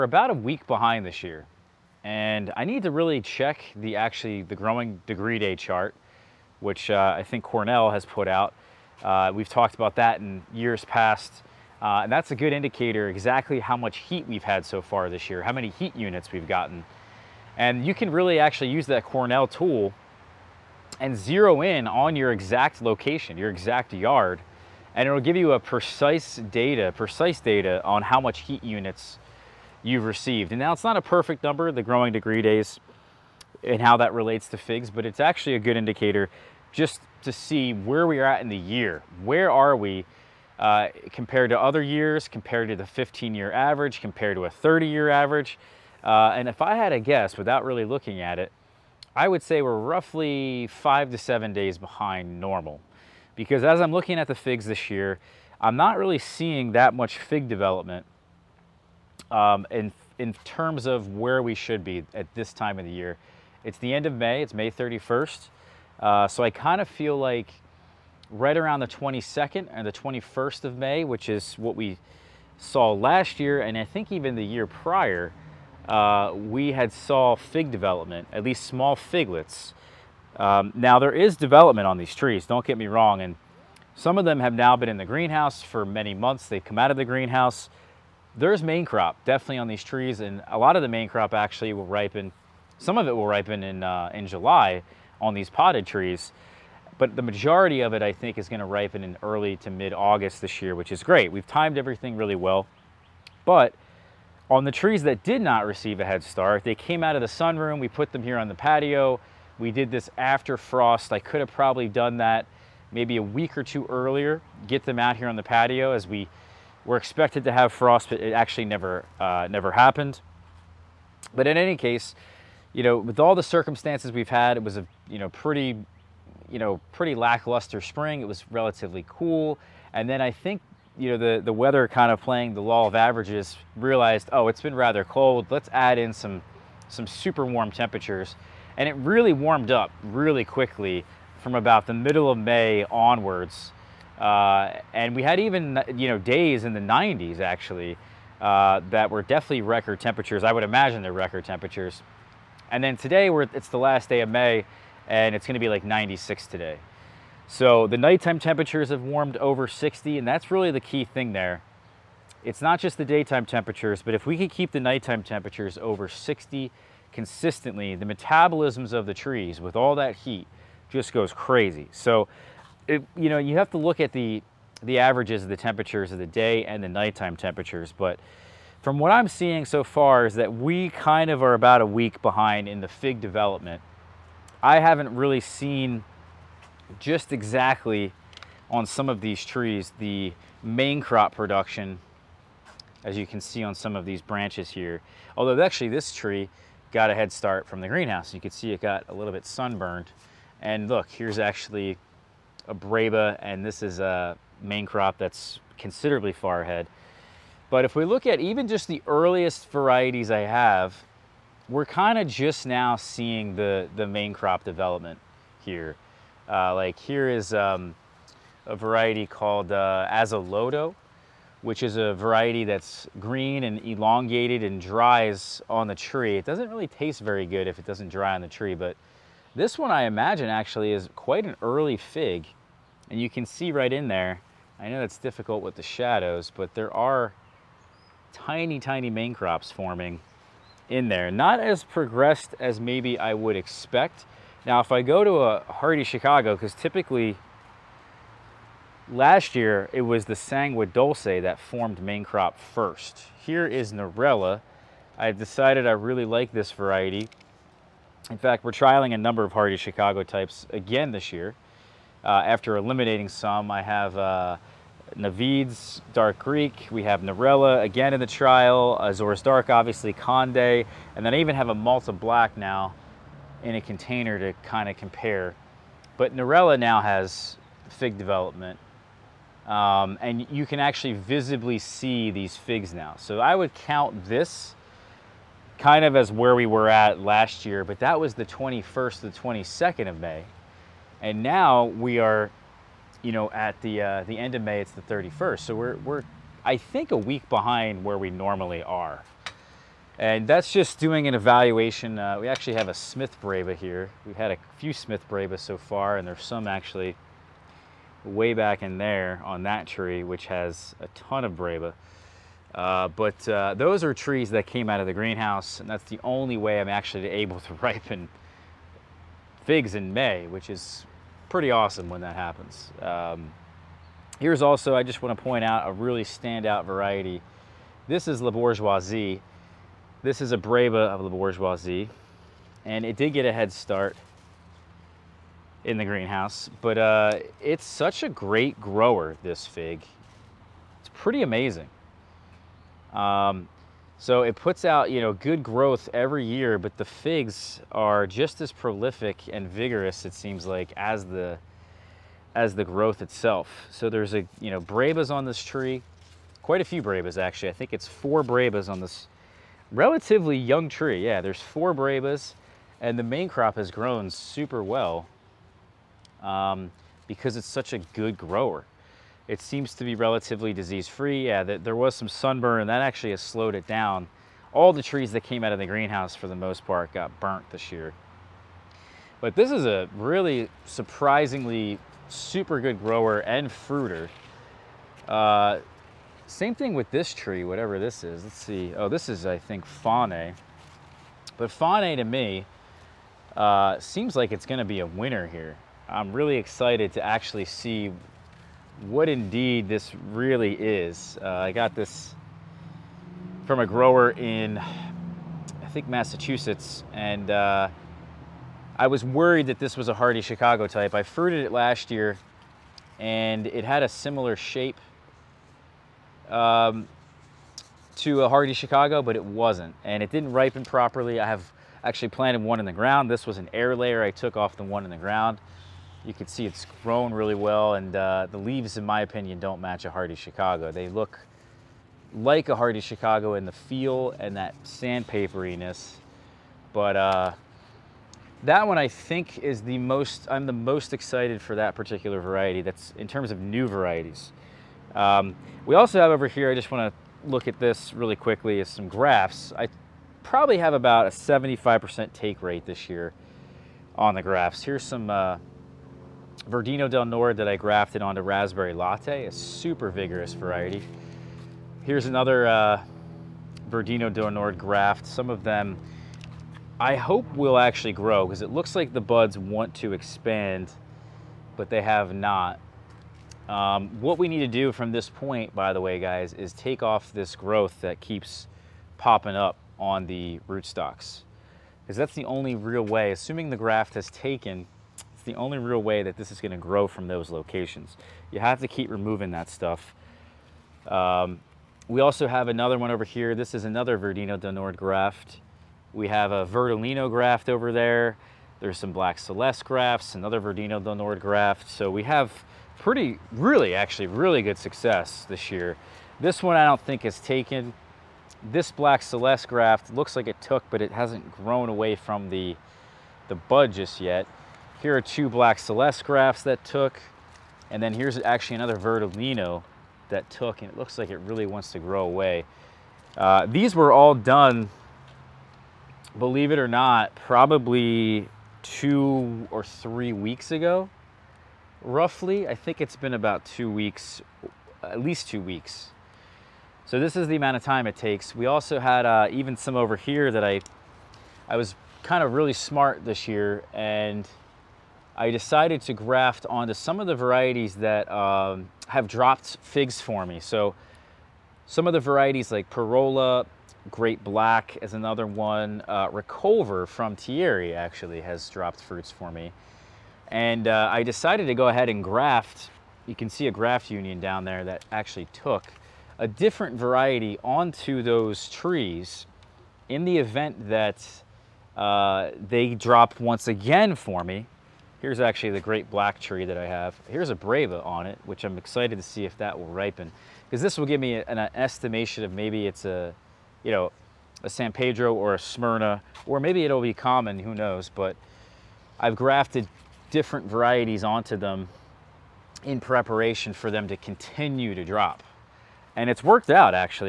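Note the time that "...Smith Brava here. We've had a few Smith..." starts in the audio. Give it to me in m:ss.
5:02.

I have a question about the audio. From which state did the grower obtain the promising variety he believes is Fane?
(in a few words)
Massachusetts.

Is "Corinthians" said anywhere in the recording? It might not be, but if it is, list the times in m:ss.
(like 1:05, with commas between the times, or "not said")
not said.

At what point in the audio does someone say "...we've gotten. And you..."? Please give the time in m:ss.
0:16.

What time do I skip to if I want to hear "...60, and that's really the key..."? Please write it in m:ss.
2:39.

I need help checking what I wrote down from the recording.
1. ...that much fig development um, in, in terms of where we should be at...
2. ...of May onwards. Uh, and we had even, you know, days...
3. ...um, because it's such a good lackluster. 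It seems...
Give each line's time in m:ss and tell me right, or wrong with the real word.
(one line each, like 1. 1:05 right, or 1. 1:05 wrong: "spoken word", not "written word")
1. 0:56 right
2. 2:22 right
3. 6:06 wrong: "grower", not "lackluster".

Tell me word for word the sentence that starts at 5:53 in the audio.
So there's a, you know, brabas on this tree, quite a few brabas actually.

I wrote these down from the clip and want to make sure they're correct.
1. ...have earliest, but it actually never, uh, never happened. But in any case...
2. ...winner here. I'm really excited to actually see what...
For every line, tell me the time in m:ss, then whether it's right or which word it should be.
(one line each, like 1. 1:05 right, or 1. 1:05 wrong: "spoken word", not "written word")
1. 1:57 wrong: "frost", not "earliest"
2. 6:35 right.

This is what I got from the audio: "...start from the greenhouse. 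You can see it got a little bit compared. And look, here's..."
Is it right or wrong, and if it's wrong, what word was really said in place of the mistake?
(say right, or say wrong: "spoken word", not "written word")
wrong: "sunburned", not "compared".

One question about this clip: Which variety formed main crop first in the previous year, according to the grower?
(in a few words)
Sangua Dulce.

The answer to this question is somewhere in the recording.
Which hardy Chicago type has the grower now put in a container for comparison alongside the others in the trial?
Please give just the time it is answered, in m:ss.
4:31.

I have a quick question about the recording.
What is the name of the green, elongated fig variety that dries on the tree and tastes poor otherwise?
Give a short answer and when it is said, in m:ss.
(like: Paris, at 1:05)
Azoloto, at 3:40.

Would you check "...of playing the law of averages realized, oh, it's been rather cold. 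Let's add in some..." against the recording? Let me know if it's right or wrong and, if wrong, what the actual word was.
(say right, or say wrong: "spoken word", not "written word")
right.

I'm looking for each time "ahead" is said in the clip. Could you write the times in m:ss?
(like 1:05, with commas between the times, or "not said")
3:26, 9:21.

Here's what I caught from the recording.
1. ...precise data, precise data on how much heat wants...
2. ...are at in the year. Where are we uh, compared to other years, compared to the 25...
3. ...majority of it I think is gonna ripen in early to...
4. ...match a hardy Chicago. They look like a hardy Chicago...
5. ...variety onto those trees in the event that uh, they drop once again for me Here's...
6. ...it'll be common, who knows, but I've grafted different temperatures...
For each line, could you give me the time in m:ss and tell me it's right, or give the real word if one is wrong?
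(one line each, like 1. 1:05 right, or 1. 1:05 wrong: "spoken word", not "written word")
1. 0:25 wrong: "units", not "wants"
2. 0:38 wrong: "15", not "25"
3. 1:37 right
4. 7:09 right
5. 9:26 right
6. 9:46 wrong: "varieties", not "temperatures".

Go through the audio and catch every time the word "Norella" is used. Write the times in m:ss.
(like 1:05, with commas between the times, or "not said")
4:13, 4:27, 4:36.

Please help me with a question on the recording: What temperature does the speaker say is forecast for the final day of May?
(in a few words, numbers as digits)
96.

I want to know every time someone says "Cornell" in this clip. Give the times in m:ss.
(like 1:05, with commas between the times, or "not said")
0:07, 0:19.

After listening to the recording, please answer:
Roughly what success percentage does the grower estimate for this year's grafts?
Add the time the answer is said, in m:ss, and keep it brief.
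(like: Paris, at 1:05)
75%, at 7:31.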